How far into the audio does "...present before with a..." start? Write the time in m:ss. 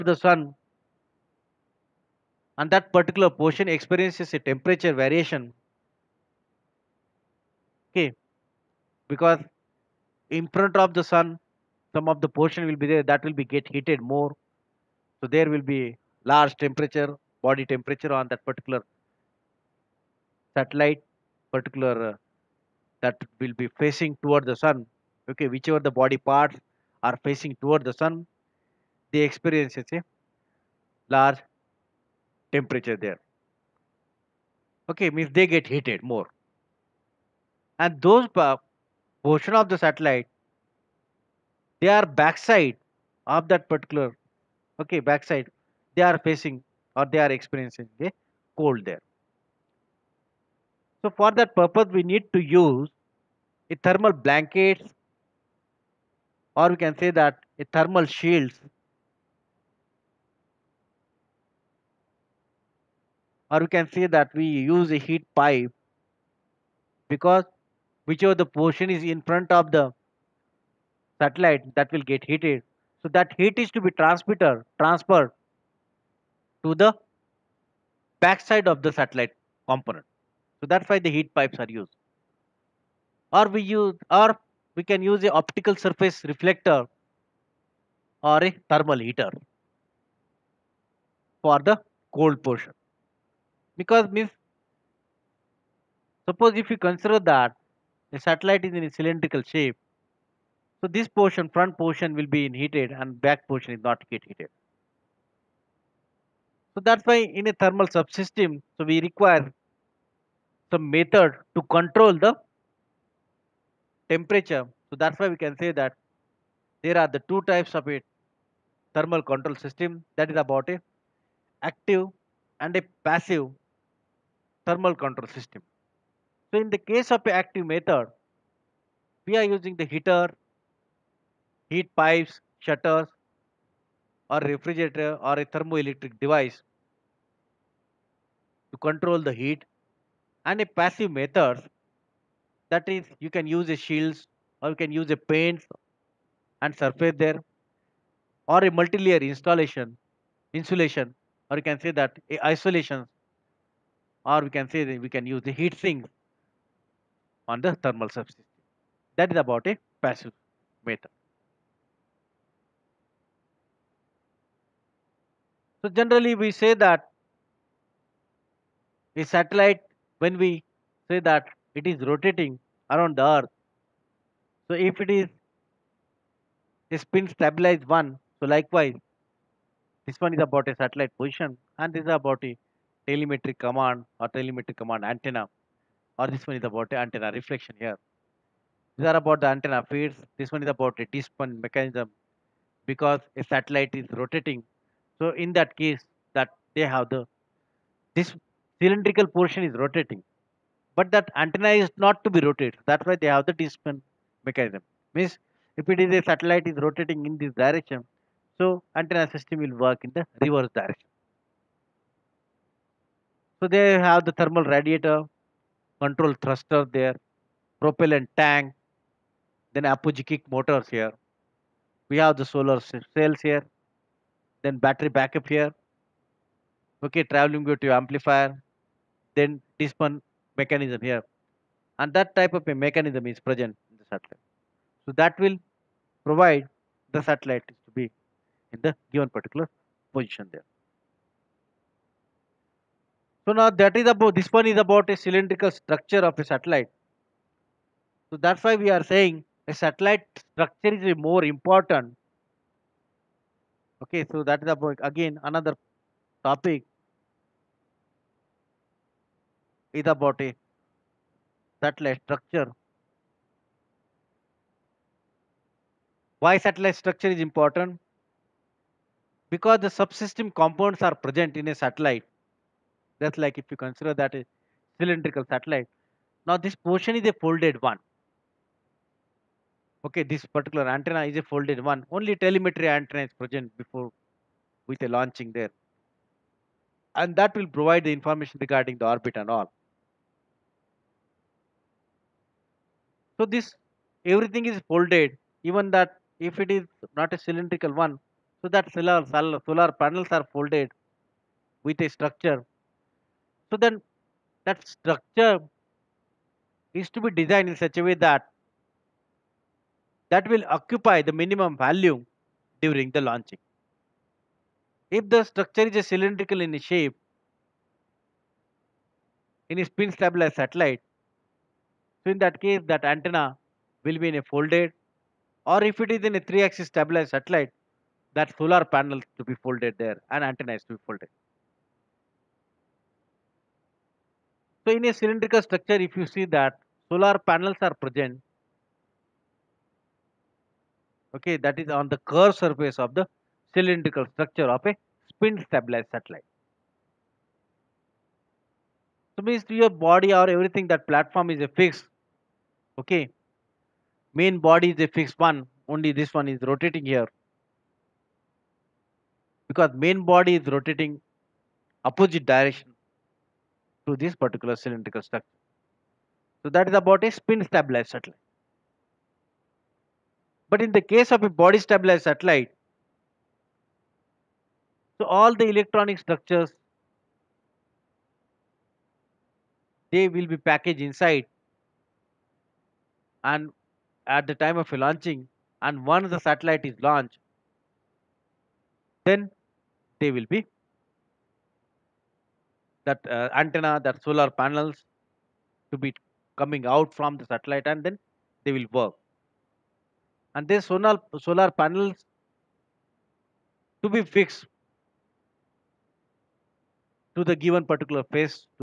4:43.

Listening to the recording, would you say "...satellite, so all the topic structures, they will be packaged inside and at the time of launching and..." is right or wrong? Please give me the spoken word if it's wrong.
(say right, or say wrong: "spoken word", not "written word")
wrong: "electronic", not "topic".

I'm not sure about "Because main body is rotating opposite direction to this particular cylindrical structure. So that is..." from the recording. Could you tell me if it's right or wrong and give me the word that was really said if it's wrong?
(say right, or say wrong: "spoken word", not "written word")
right.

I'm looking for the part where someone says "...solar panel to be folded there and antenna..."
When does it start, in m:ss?
5:28.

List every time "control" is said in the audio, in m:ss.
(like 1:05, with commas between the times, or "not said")
1:51, 1:59, 2:04, 2:18, 3:35.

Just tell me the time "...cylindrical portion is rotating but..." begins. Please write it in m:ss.
3:18.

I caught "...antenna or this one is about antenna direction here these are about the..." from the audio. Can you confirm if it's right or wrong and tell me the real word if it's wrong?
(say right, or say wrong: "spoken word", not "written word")
wrong: "reflection", not "direction".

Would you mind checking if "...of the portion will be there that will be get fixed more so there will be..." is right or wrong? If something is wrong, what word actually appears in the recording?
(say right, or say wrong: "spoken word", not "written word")
wrong: "heated", not "fixed".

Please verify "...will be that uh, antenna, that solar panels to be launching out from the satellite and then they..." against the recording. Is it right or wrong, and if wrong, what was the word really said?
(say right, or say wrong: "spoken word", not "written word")
wrong: "coming", not "launching".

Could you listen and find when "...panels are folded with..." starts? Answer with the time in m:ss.
5:00.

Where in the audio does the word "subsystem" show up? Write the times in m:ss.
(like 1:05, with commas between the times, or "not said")
1:47, 2:38, 4:29.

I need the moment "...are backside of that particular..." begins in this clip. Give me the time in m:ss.
0:41.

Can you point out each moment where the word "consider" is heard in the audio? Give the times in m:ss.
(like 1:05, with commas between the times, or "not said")
1:36, 4:33.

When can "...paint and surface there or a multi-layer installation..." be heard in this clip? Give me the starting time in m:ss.
2:25.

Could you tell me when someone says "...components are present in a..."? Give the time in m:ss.
4:30.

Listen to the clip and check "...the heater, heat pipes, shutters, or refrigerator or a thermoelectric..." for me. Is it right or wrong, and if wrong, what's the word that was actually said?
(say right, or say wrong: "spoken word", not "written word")
right.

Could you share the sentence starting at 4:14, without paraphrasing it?
Okay, so that is about again another topic is about a satellite structure.